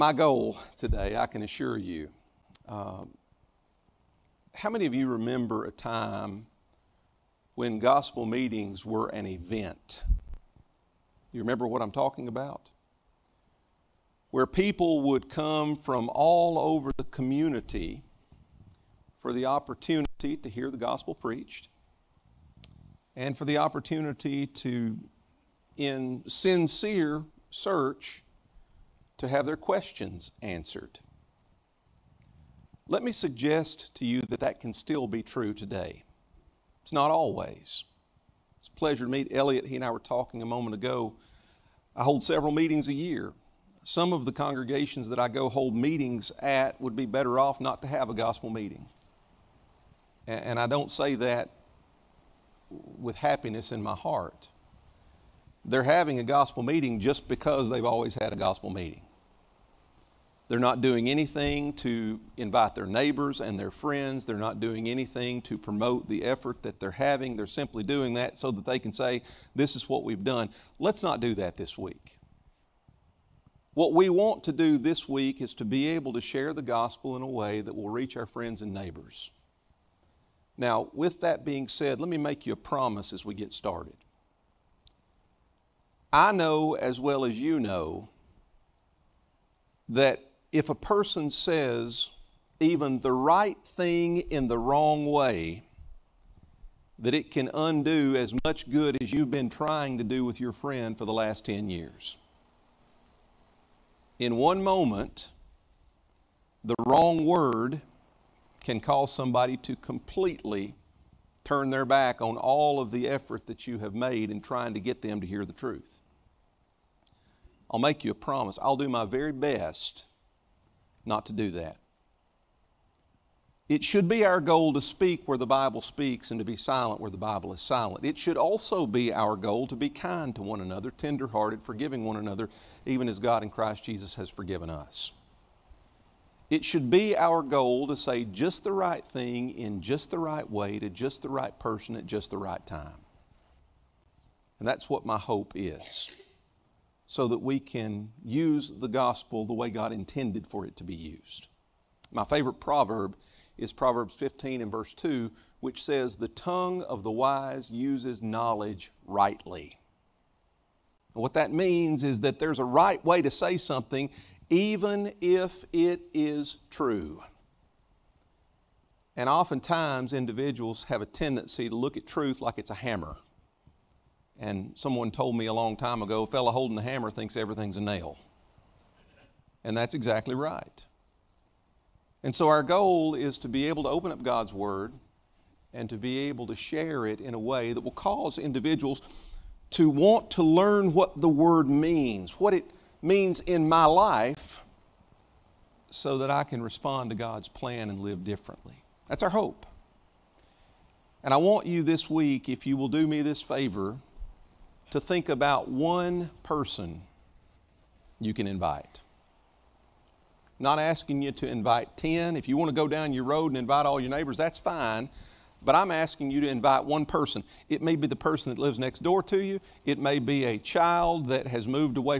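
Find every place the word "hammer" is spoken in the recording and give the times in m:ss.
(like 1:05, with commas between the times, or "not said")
2:52, 2:56.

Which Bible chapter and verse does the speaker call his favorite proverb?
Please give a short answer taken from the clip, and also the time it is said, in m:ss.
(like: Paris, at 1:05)
Proverbs 15:2, at 2:33.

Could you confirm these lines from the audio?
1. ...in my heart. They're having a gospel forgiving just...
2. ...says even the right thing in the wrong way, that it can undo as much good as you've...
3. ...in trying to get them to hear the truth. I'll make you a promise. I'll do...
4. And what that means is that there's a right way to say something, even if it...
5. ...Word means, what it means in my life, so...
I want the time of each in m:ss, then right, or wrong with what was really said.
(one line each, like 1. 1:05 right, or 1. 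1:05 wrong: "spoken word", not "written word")
1. 0:53 wrong: "meeting", not "forgiving"
2. 1:31 right
3. 1:54 right
4. 2:41 right
5. 3:11 right.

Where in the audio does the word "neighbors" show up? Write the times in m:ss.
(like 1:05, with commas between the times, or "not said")
1:02, 1:18, 3:34.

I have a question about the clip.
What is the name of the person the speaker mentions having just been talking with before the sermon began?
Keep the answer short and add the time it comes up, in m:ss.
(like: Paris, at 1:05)
Elliot, at 0:39.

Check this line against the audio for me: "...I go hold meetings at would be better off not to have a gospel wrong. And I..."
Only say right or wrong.
wrong.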